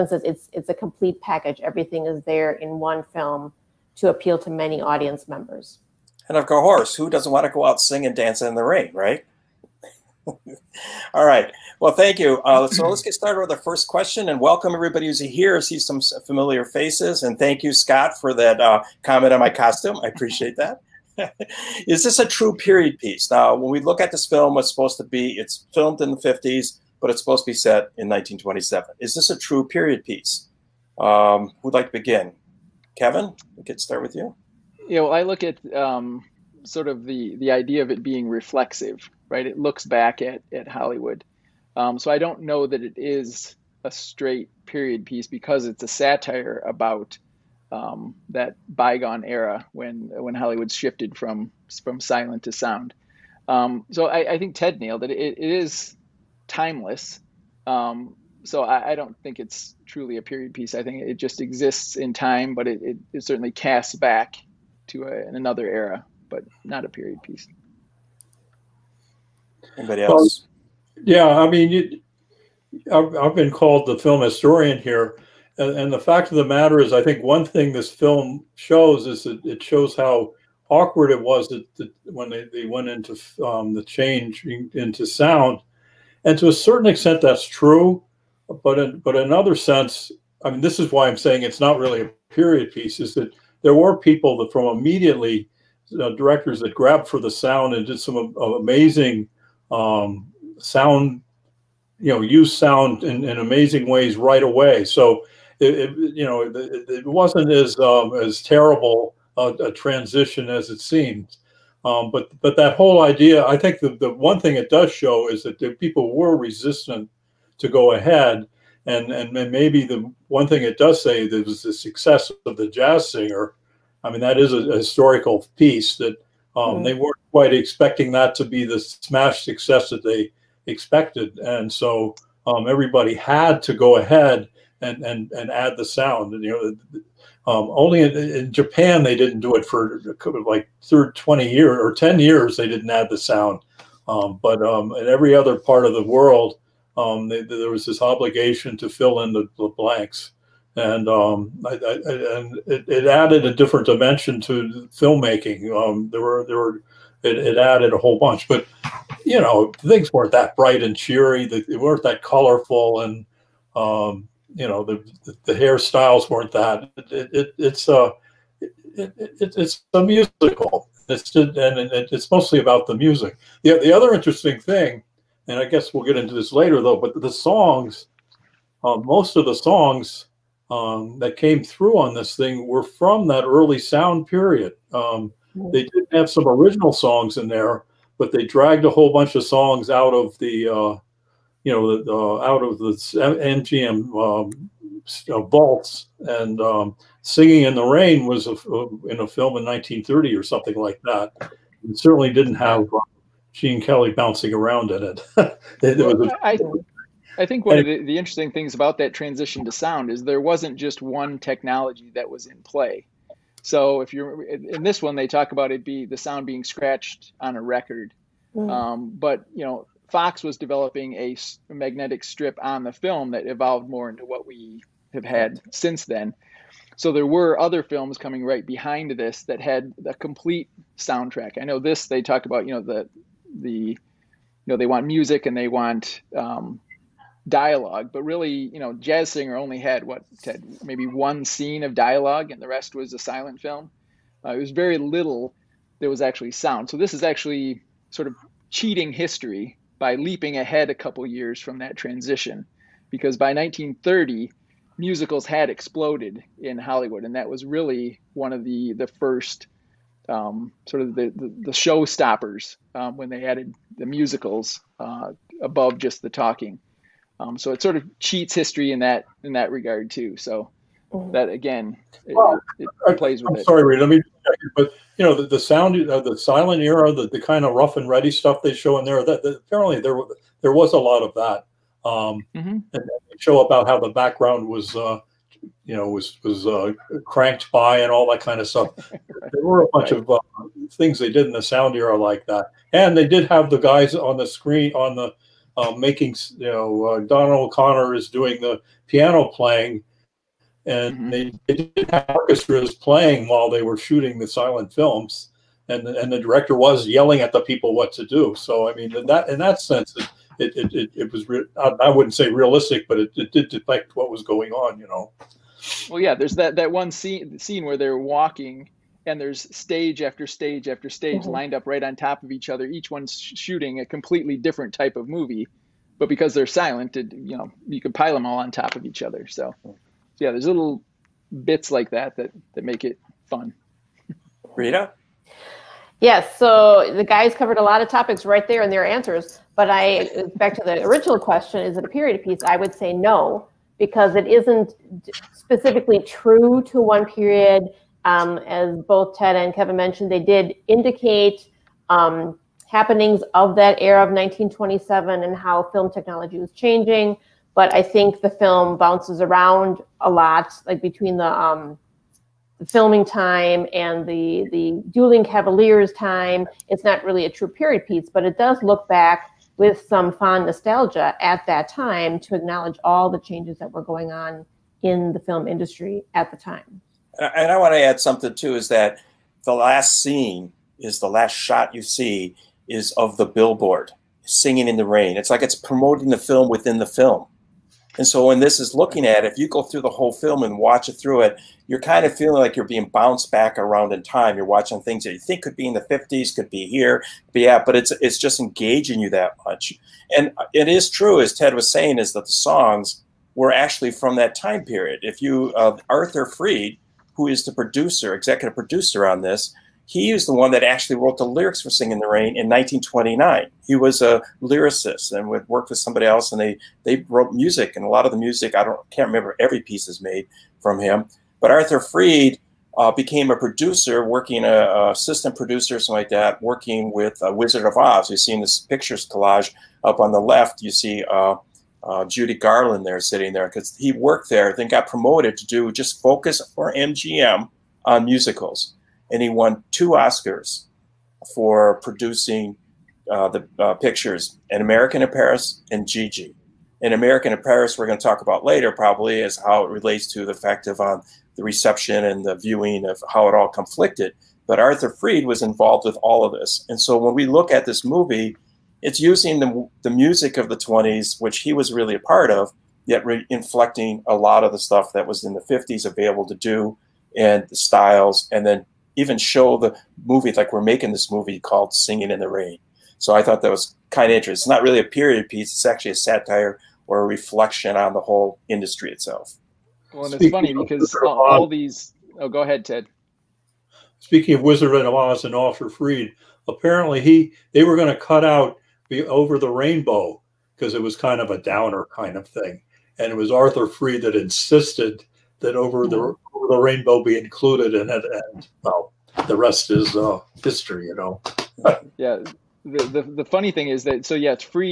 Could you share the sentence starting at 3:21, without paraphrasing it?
It certainly didn't have uh, Gene Kelly bouncing around in it.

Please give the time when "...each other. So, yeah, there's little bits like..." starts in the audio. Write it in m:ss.
5:29.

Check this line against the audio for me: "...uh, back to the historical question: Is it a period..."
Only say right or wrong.
wrong.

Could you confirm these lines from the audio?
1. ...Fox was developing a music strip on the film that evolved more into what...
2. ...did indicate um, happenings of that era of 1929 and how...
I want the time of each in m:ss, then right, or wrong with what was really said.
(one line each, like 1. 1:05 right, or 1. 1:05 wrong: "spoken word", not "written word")
1. 3:40 wrong: "magnetic", not "music"
2. 5:50 wrong: "1927", not "1929".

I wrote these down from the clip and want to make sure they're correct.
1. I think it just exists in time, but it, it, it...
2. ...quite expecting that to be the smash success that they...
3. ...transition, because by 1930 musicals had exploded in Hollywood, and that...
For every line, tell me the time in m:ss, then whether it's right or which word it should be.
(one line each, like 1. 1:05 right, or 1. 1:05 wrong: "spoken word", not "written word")
1. 1:00 right
2. 2:07 right
3. 4:11 right.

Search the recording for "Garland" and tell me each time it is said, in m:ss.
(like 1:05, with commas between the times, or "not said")
7:12.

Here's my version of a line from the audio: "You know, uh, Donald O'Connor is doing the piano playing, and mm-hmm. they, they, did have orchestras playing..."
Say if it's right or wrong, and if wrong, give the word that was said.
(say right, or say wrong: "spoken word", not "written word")
right.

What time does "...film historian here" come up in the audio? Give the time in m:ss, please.
1:13.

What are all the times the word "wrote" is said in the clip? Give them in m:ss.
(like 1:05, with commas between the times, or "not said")
6:51, 6:57.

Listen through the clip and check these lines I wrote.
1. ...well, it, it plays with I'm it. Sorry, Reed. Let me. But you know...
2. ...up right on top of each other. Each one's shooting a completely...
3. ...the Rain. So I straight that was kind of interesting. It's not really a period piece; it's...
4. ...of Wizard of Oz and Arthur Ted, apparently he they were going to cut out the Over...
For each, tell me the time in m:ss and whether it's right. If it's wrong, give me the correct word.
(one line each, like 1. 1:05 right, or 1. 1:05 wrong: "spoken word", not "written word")
1. 4:32 right
2. 5:21 right
3. 7:52 wrong: "thought", not "straight"
4. 8:04 wrong: "Freed", not "Ted".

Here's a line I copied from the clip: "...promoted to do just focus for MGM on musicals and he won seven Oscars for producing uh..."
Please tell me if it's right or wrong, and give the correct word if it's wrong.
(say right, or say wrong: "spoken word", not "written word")
wrong: "two", not "seven".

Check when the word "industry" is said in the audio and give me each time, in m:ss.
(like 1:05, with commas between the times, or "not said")
6:15, 7:58.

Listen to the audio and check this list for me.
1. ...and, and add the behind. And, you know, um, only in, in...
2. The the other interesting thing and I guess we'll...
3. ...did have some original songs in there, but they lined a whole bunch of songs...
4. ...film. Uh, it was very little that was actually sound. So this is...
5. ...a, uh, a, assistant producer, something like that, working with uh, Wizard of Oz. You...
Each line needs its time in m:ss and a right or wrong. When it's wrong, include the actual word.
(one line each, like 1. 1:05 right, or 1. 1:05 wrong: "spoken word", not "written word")
1. 2:15 wrong: "sound", not "behind"
2. 2:53 right
3. 3:05 wrong: "dragged", not "lined"
4. 4:03 right
5. 7:04 right.